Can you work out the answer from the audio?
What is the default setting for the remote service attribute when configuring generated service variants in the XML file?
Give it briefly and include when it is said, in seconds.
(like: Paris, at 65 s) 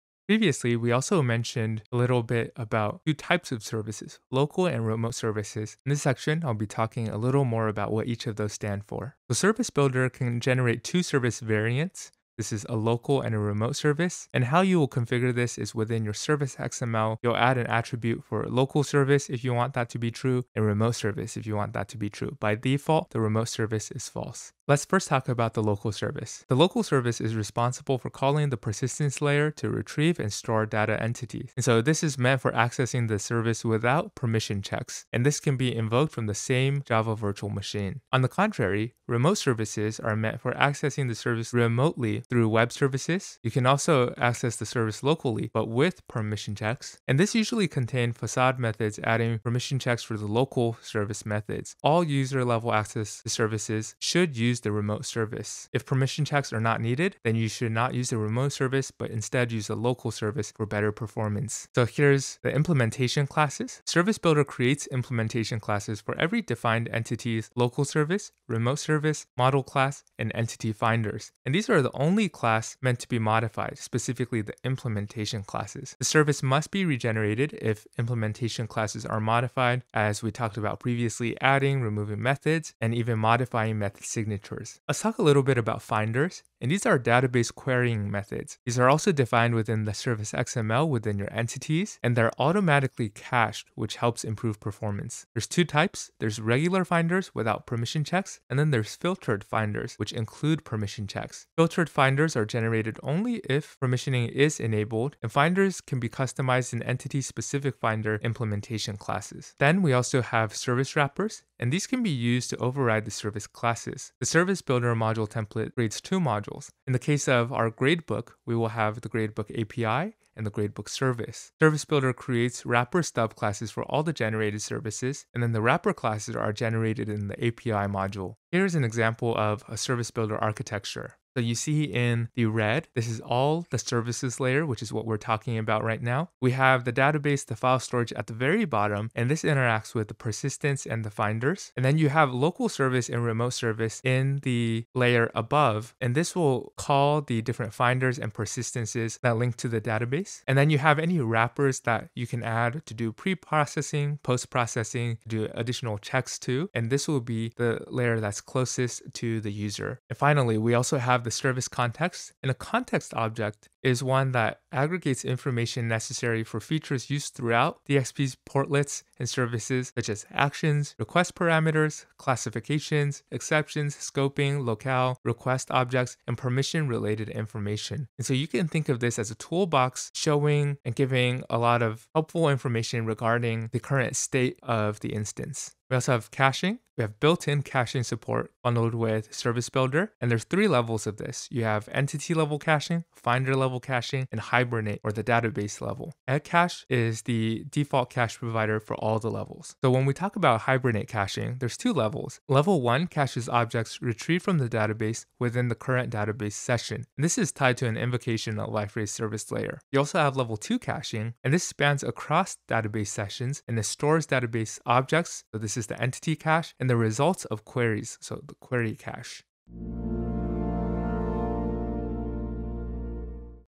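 False, at 23 s.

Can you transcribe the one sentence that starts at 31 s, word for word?
And so this is meant for accessing the service without permission checks.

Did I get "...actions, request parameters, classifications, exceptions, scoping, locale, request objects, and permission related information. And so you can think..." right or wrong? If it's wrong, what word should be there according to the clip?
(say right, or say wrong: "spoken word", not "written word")
right.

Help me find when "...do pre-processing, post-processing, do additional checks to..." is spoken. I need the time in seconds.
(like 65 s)
152 s.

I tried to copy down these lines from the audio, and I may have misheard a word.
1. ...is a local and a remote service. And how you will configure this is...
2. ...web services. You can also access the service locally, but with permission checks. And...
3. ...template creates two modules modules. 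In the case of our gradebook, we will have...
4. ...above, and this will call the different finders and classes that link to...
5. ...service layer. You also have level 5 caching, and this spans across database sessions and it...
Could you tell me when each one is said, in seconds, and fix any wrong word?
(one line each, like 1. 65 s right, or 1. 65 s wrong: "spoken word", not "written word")
1. 12 s right
2. 42 s right
3. 115 s right
4. 145 s wrong: "persistences", not "classes"
5. 209 s wrong: "2", not "5".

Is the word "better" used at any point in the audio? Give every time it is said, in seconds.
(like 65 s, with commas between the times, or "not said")
60 s.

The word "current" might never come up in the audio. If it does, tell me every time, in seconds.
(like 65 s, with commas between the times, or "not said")
183 s, 205 s.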